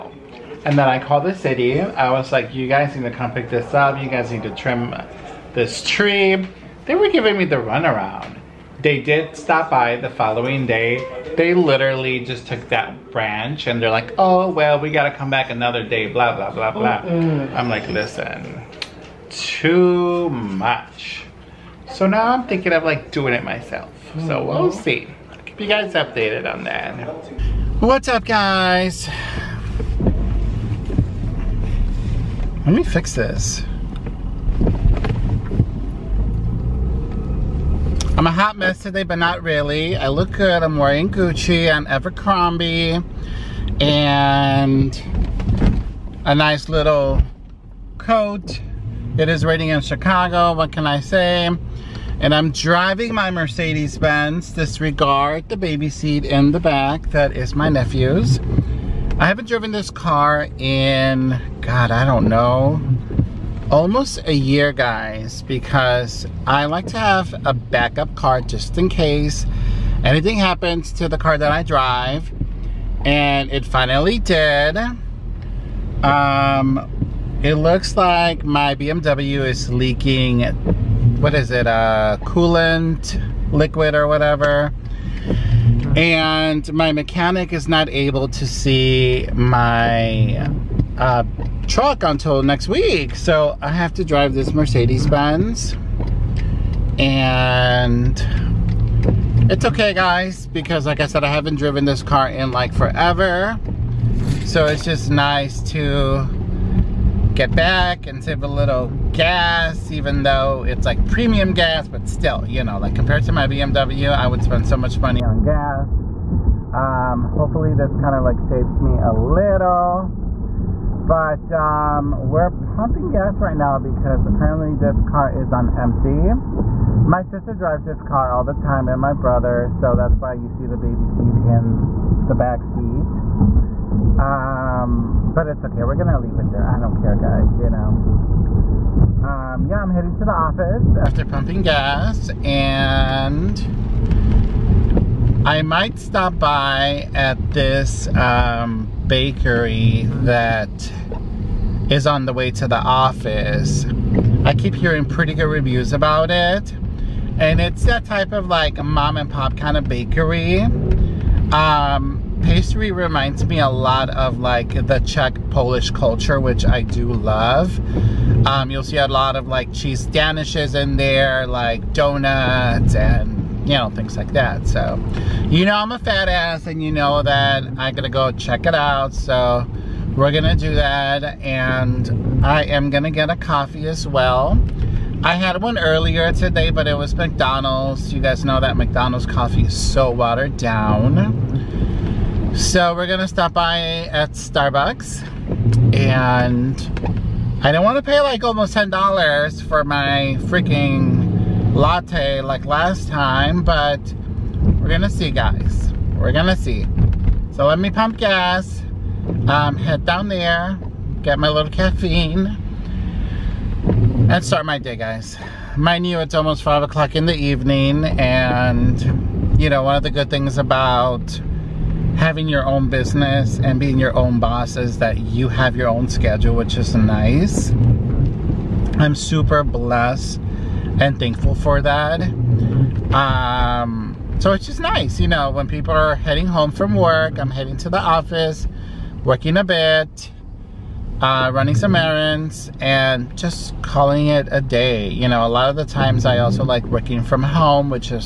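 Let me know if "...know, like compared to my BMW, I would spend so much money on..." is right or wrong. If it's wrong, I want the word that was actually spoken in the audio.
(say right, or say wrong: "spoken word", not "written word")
right.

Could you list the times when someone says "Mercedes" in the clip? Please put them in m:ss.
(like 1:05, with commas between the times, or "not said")
0:53, 1:34.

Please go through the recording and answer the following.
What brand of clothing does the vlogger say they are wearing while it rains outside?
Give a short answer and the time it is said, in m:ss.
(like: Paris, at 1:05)
Gucci, at 0:41.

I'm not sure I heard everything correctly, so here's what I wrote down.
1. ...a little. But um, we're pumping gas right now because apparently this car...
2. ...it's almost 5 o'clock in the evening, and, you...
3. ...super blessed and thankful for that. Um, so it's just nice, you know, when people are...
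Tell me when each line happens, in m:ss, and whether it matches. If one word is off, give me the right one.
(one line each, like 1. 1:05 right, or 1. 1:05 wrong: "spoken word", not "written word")
1. 1:58 right
2. 3:36 right
3. 3:49 right.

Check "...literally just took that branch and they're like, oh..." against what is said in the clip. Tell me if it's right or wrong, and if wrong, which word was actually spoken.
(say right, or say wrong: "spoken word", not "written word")
right.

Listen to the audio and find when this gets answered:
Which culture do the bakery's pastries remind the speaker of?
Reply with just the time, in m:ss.
2:44.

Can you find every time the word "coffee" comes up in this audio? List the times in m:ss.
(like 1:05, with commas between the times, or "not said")
3:03, 3:09.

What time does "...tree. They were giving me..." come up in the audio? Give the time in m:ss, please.
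0:05.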